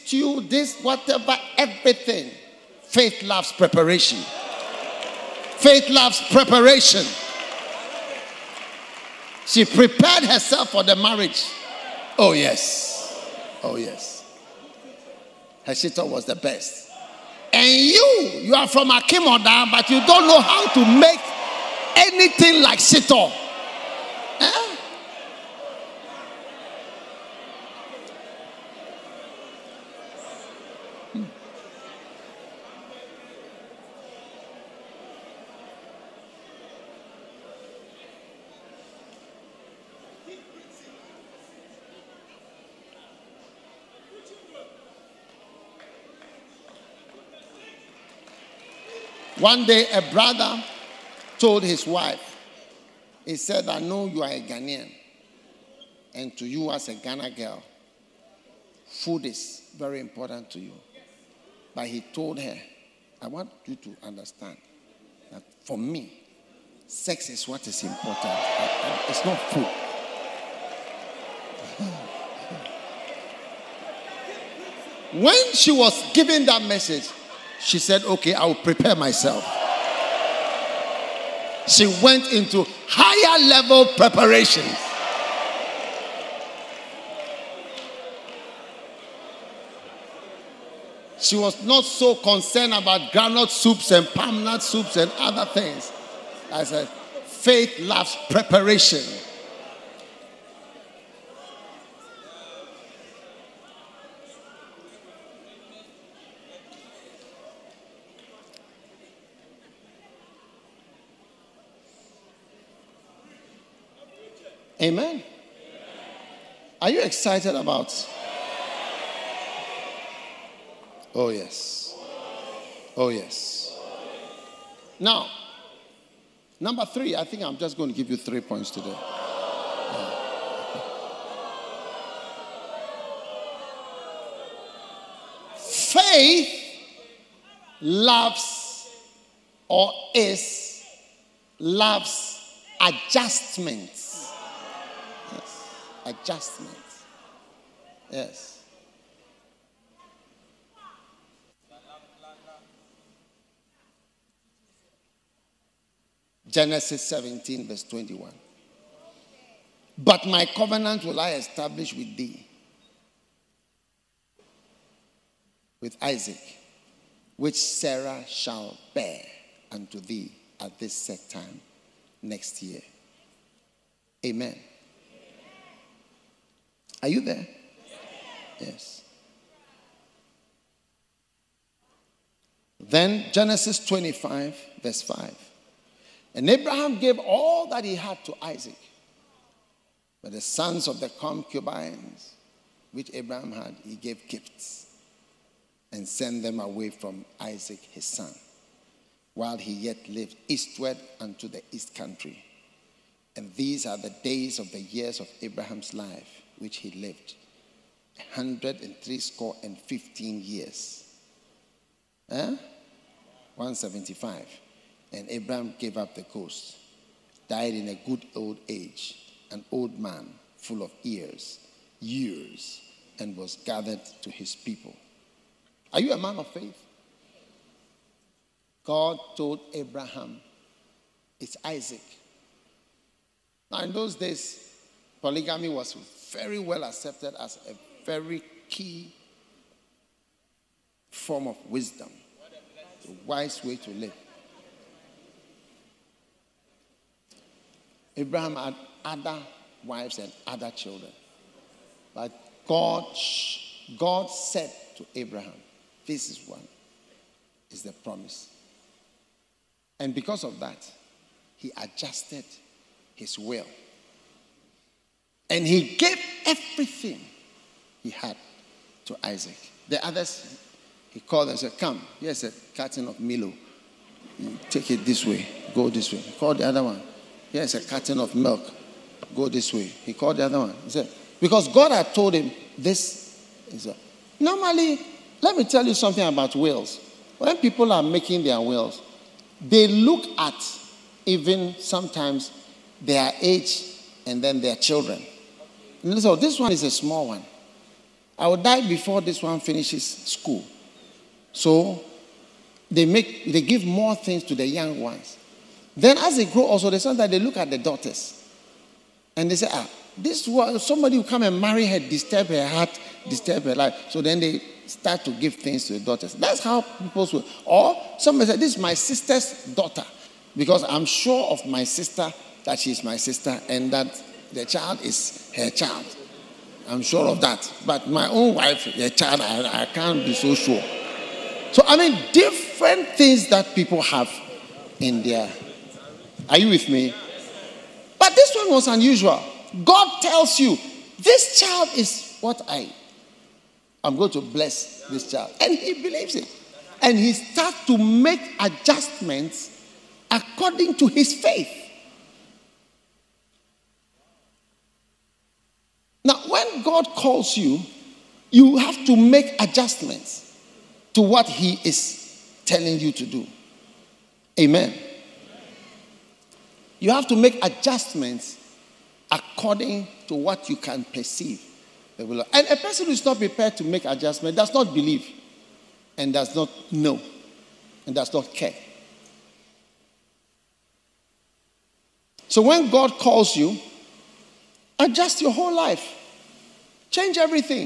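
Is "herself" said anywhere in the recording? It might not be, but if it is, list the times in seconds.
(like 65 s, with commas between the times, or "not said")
10 s.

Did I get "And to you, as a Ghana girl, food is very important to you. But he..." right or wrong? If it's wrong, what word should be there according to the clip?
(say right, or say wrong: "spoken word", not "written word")
right.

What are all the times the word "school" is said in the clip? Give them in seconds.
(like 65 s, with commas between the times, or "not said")
300 s.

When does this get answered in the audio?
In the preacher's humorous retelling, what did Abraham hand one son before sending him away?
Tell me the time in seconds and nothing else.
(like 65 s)
272 s.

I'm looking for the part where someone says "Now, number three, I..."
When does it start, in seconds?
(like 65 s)
124 s.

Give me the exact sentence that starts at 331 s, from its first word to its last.
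So, I mean, different things that people have in their.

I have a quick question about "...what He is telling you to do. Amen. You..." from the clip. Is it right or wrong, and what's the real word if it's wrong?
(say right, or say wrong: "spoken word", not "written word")
right.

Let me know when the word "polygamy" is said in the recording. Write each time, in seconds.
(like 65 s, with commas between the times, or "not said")
235 s.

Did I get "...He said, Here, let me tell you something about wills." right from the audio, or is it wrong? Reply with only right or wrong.
wrong.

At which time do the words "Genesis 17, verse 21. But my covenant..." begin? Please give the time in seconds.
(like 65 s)
156 s.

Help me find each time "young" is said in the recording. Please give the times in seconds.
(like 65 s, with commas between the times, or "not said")
304 s.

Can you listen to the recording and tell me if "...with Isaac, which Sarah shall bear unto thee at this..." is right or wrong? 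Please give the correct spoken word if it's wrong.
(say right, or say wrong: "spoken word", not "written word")
right.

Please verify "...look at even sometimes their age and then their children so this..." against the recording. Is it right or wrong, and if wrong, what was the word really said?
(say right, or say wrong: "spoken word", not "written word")
right.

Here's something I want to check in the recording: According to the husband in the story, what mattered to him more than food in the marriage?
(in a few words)
Sex.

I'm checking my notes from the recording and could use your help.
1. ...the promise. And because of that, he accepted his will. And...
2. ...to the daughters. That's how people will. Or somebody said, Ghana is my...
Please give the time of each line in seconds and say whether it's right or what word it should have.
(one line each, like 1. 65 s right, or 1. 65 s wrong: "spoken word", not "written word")
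1. 257 s wrong: "adjusted", not "accepted"
2. 315 s wrong: "This", not "Ghana".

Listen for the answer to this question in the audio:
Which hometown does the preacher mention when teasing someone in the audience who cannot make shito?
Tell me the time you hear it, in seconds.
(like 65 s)
18 s.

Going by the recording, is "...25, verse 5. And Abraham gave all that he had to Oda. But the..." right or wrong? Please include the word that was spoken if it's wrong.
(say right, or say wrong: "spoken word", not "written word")
wrong: "Isaac", not "Oda".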